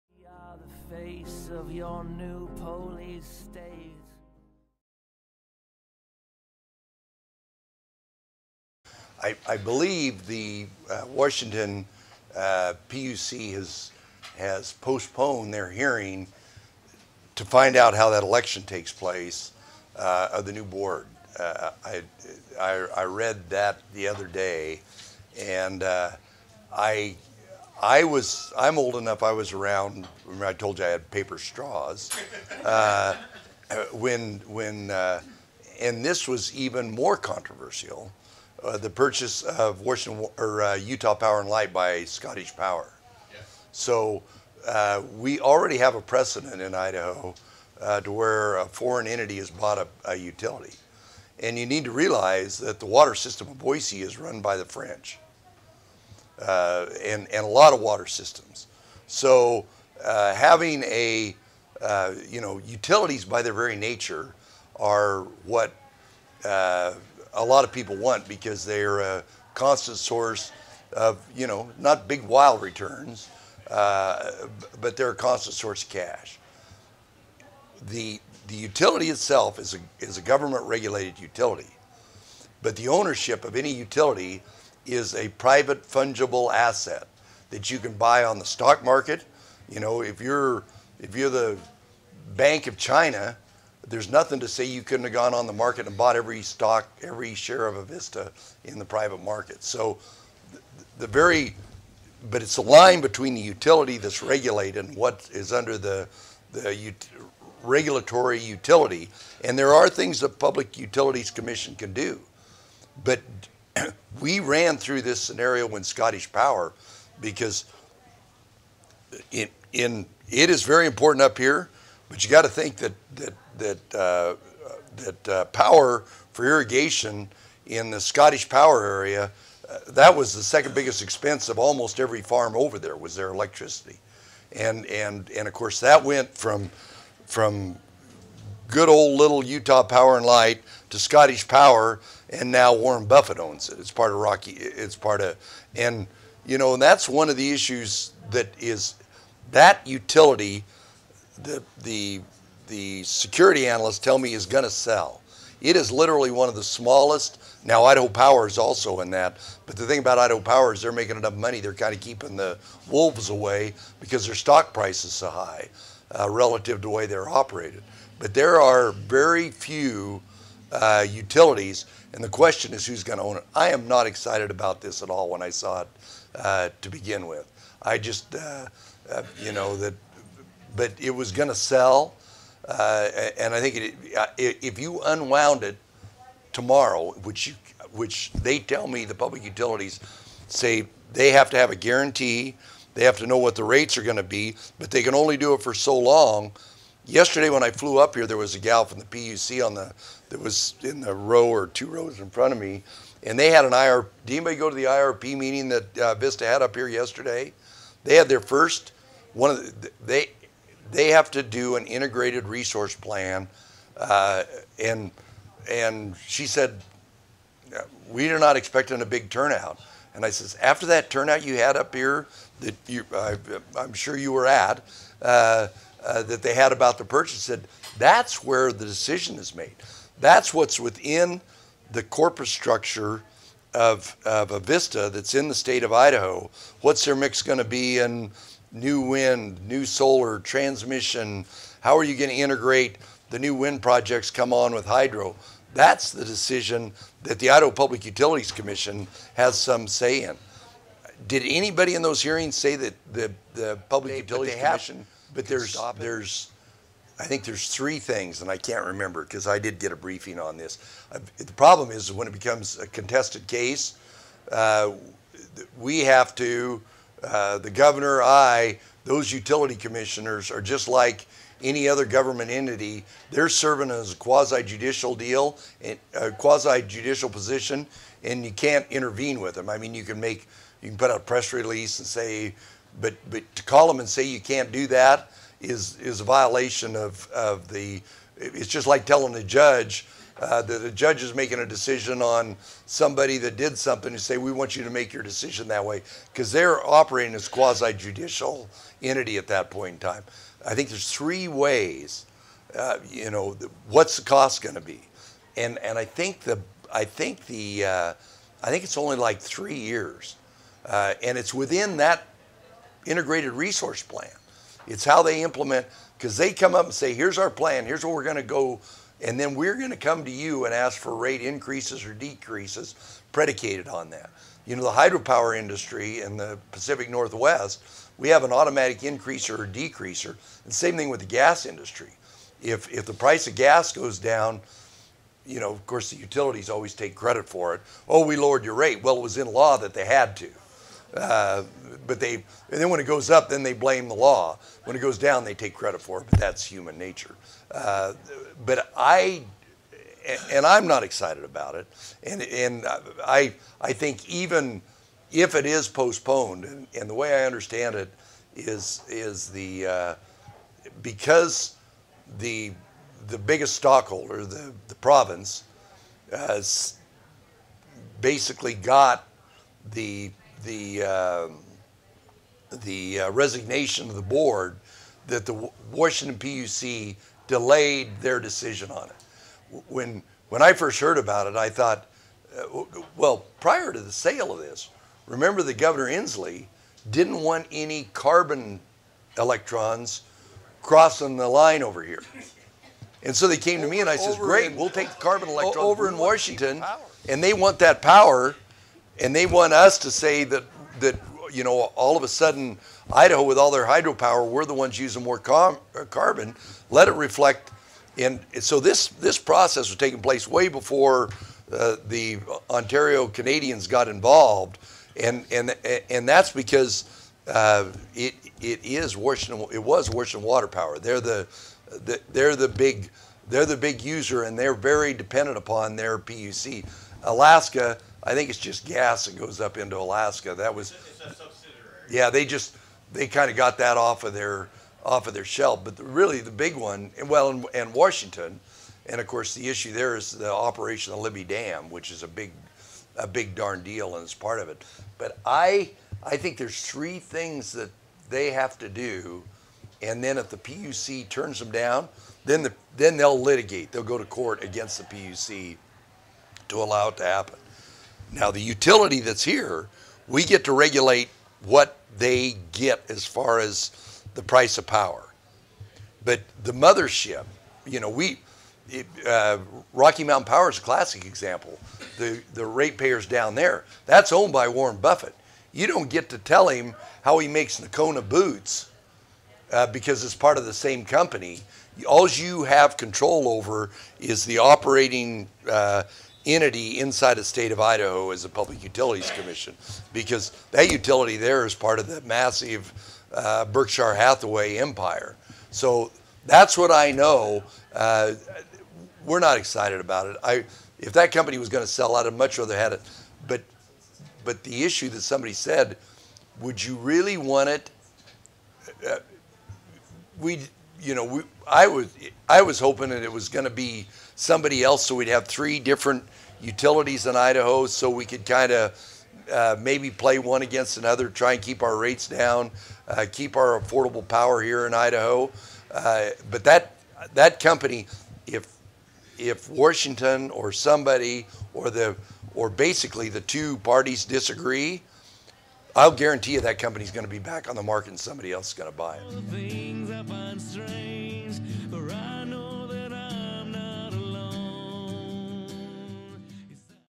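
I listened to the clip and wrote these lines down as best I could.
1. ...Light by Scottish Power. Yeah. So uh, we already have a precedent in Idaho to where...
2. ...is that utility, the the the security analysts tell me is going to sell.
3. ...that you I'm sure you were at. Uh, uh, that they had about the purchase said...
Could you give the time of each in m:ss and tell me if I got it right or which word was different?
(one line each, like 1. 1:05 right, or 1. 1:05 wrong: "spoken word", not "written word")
1. 0:41 right
2. 2:28 right
3. 3:42 right.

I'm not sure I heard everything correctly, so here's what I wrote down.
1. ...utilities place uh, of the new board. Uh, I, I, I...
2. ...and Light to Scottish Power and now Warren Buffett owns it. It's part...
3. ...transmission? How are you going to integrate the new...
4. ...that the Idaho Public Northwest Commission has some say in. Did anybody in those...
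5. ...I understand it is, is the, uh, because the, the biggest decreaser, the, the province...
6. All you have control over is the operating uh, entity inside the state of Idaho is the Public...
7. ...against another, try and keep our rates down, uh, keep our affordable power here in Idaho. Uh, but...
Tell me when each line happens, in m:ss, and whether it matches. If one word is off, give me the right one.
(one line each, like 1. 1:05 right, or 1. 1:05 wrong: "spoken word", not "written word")
1. 0:18 wrong: "takes", not "utilities"
2. 2:20 right
3. 4:00 right
4. 4:07 wrong: "Utilities", not "Northwest"
5. 5:57 wrong: "stockholder", not "decreaser"
6. 8:02 right
7. 8:40 right.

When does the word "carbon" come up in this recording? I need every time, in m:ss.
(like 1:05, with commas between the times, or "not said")
6:28, 6:35, 6:46.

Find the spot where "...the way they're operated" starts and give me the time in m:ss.
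2:46.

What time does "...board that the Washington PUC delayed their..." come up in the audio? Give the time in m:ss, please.
6:14.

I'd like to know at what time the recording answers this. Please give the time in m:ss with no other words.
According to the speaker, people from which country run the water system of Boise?
0:54.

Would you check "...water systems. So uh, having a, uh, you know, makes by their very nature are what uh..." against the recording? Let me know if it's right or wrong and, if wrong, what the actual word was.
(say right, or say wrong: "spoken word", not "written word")
wrong: "utilities", not "makes".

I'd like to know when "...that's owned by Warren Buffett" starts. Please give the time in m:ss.
7:54.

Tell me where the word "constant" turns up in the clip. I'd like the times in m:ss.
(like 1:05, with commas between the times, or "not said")
1:09, 1:15.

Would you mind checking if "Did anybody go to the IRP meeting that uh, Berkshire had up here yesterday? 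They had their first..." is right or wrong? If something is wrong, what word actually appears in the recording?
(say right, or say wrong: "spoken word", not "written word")
wrong: "Vista", not "Berkshire".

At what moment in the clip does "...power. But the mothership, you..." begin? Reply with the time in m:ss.
7:44.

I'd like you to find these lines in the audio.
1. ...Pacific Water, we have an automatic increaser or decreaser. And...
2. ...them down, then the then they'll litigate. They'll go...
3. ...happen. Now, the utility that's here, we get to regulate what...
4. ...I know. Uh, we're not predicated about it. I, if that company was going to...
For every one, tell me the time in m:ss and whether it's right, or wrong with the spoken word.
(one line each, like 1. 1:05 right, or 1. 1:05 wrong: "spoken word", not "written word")
1. 5:26 wrong: "Northwest", not "Water"
2. 7:31 right
3. 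7:37 right
4. 8:16 wrong: "excited", not "predicated".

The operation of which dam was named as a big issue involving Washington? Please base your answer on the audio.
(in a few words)
Libby Dam.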